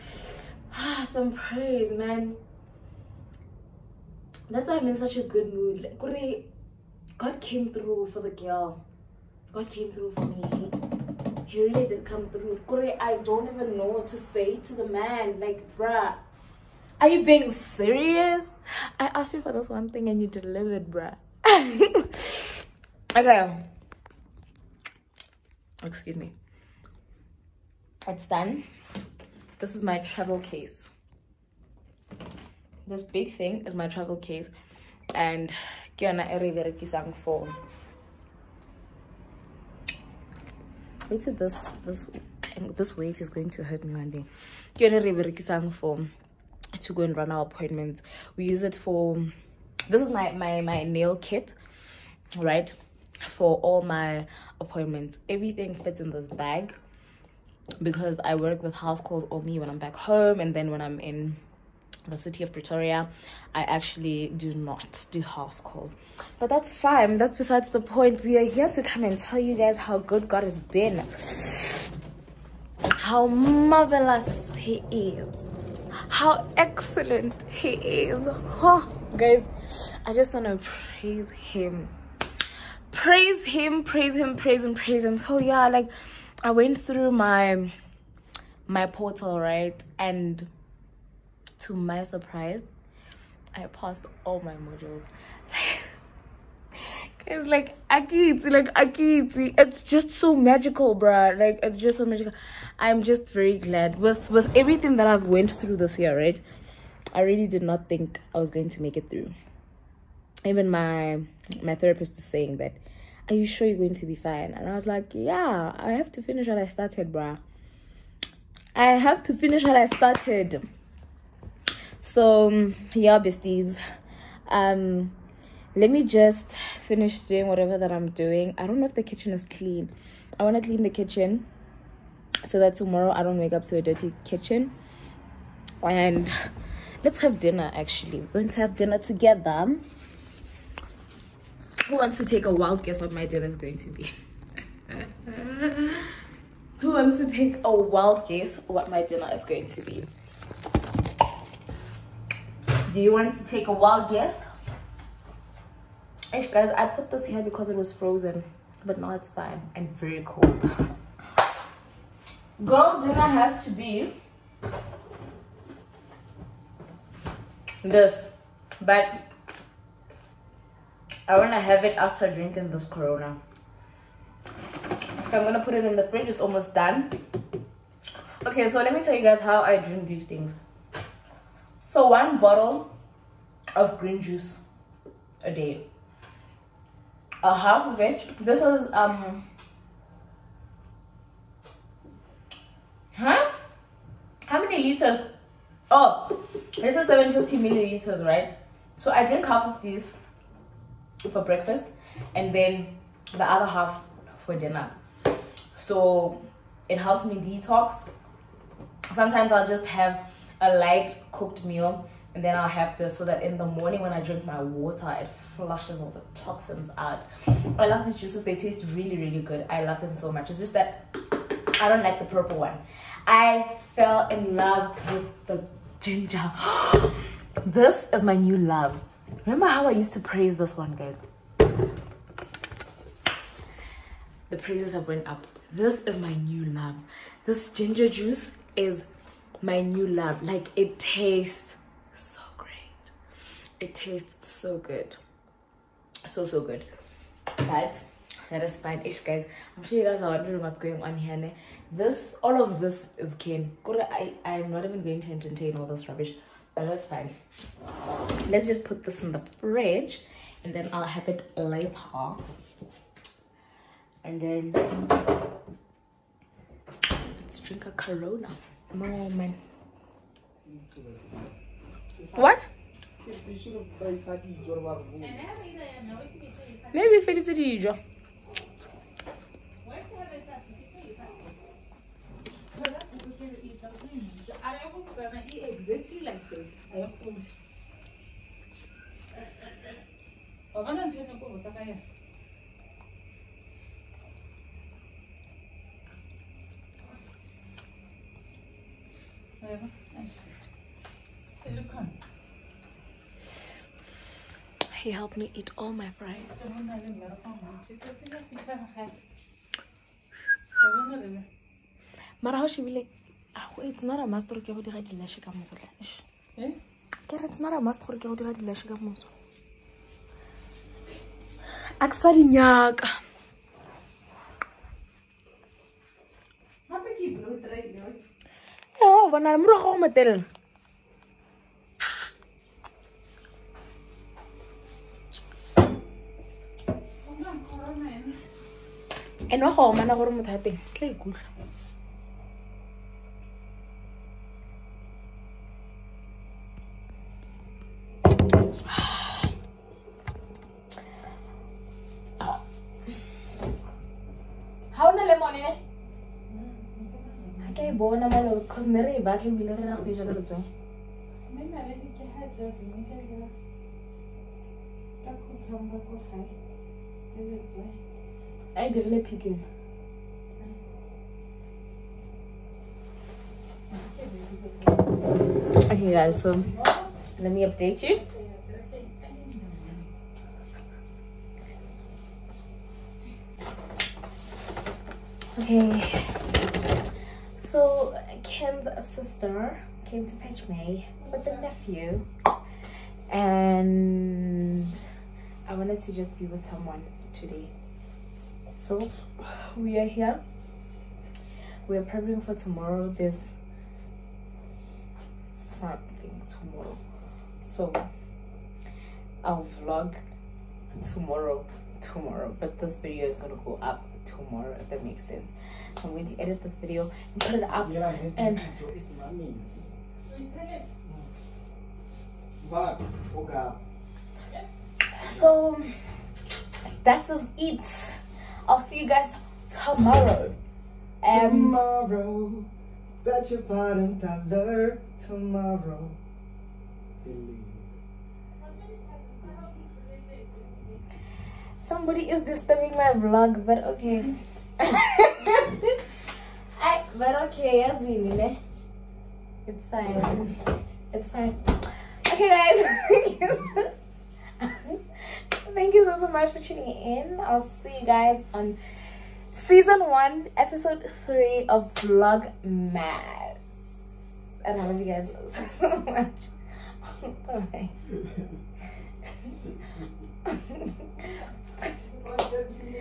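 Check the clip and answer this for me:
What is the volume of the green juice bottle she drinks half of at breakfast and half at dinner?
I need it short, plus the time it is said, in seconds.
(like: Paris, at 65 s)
750 milliliters, at 197 s.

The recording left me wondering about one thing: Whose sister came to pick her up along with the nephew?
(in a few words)
Kim's.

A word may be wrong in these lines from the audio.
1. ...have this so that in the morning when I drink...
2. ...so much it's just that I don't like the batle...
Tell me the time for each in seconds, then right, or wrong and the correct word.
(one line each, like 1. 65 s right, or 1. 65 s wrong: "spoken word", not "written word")
1. 212 s right
2. 220 s wrong: "purple", not "batle".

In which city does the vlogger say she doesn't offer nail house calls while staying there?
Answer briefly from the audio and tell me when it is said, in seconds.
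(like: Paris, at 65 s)
Pretoria, at 62 s.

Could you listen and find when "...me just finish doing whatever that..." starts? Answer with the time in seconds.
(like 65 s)
125 s.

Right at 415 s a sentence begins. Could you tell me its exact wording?
So I'm going to edit this video and put it up.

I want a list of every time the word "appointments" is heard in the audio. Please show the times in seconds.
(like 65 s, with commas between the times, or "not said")
47 s, 54 s.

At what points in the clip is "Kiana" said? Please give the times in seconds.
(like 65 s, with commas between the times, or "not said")
35 s.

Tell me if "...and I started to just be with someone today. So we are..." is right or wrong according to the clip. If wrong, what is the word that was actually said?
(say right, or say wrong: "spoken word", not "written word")
wrong: "wanted", not "started".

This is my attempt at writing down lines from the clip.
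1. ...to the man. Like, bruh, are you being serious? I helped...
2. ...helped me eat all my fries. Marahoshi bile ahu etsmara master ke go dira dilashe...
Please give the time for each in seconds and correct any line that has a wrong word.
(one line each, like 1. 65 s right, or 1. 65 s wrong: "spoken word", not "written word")
1. 14 s wrong: "asked", not "helped"
2. 305 s right.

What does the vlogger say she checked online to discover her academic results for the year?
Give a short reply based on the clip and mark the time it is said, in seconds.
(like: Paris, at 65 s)
My portal, at 88 s.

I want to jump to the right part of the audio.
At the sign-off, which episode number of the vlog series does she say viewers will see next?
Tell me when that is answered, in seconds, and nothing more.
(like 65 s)
460 s.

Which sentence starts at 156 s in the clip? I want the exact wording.
Ish, guys, I put this here because it was frozen, but now it's fine and very cold.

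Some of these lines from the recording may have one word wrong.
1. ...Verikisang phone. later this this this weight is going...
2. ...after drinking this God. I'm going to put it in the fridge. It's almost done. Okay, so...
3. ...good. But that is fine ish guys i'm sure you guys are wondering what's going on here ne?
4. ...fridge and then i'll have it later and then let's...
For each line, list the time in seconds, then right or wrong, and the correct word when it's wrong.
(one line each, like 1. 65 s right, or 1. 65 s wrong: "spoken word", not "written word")
1. 36 s right
2. 171 s wrong: "Corona", not "God"
3. 246 s right
4. 259 s right.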